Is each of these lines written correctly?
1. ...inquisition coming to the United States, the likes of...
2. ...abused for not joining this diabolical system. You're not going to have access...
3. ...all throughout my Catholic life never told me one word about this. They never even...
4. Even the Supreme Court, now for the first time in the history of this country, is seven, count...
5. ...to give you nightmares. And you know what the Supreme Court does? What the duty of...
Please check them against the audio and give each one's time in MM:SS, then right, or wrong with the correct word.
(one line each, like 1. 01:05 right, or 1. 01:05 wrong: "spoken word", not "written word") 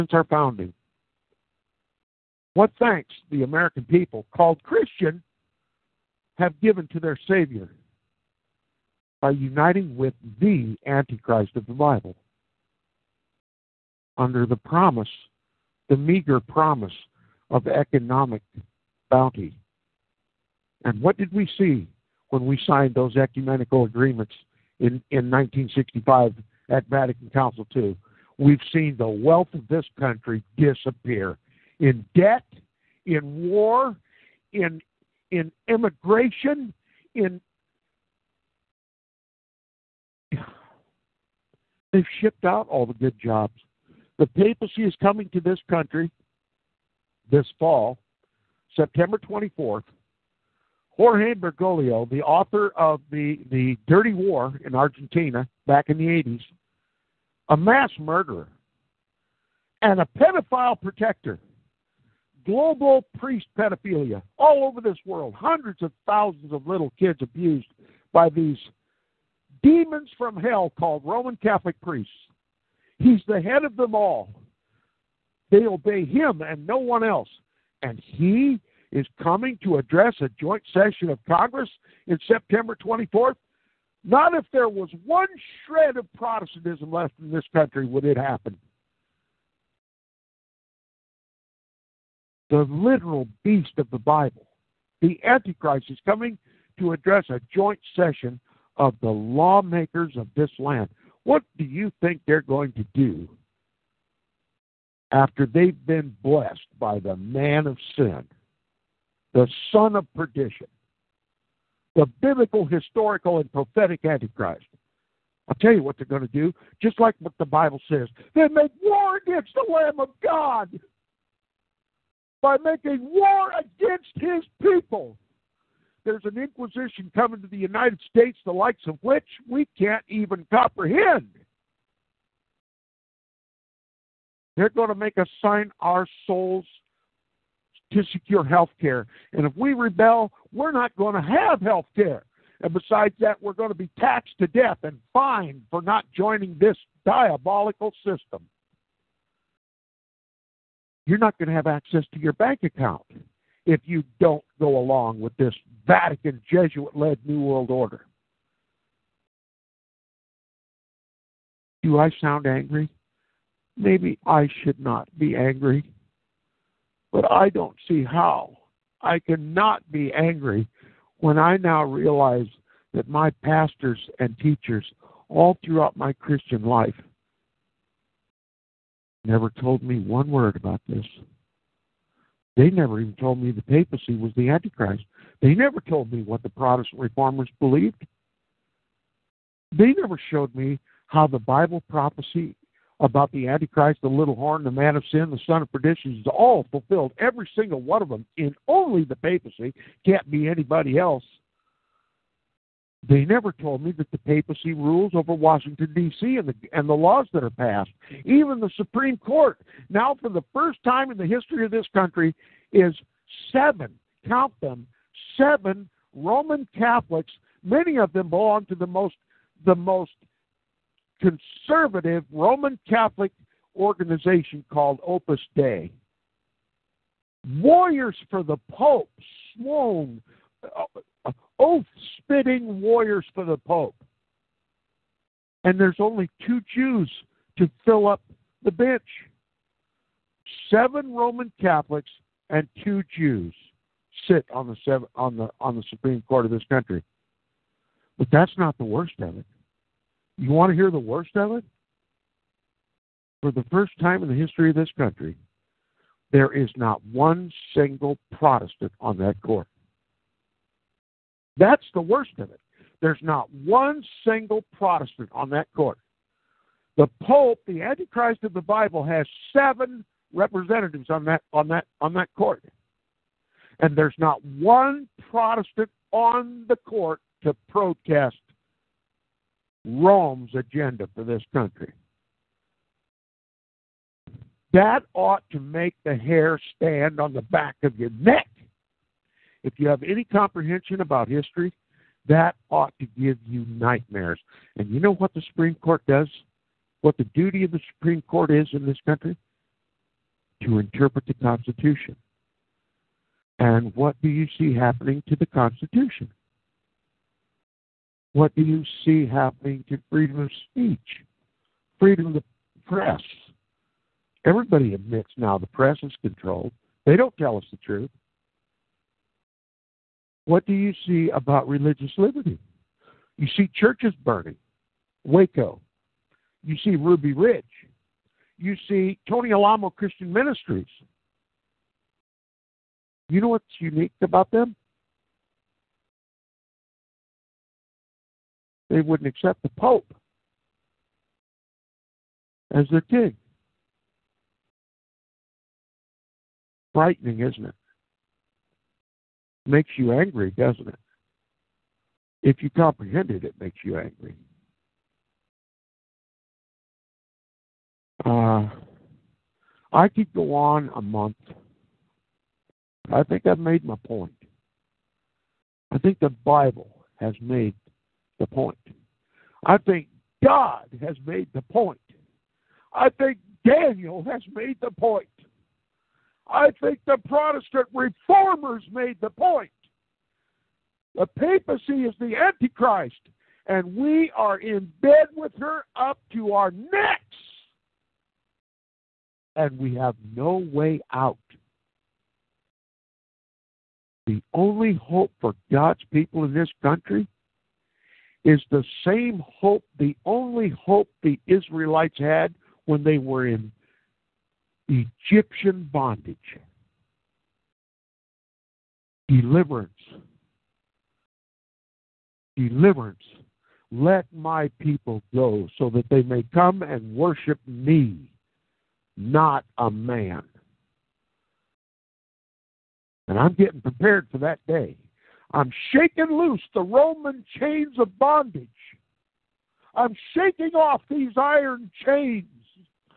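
1. 02:06 right
2. 02:25 wrong: "fined", not "abused"
3. 02:55 wrong: "Christian", not "Catholic"
4. 03:28 right
5. 04:52 right.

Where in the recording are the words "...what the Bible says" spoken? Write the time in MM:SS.
01:57.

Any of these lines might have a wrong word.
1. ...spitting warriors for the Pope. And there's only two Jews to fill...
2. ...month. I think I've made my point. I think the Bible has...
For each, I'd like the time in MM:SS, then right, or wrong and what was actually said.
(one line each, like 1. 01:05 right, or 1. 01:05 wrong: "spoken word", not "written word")
1. 03:52 right
2. 06:01 right.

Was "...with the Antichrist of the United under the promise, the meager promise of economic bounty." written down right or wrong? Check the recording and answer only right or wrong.
wrong.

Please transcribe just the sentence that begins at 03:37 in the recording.
Many of them belong to the most, the most conservative Roman Catholic organization called Opus Dei.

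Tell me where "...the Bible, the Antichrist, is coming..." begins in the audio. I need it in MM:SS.
01:33.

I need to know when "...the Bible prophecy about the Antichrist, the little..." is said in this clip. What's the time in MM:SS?
03:11.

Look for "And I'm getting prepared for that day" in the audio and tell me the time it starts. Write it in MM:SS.
07:03.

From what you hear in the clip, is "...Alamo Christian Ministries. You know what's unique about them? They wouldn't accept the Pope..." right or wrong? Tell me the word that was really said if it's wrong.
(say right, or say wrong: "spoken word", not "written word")
right.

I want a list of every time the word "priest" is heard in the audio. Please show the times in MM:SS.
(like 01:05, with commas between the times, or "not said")
01:03, 01:11.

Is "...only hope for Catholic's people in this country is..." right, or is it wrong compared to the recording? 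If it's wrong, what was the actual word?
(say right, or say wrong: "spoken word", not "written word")
wrong: "God", not "Catholic".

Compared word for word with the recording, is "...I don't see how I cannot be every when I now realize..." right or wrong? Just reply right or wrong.
wrong.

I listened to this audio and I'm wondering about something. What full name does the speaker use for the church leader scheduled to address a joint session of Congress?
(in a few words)
Jorge Bergoglio.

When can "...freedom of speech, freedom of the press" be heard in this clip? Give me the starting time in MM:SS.
05:10.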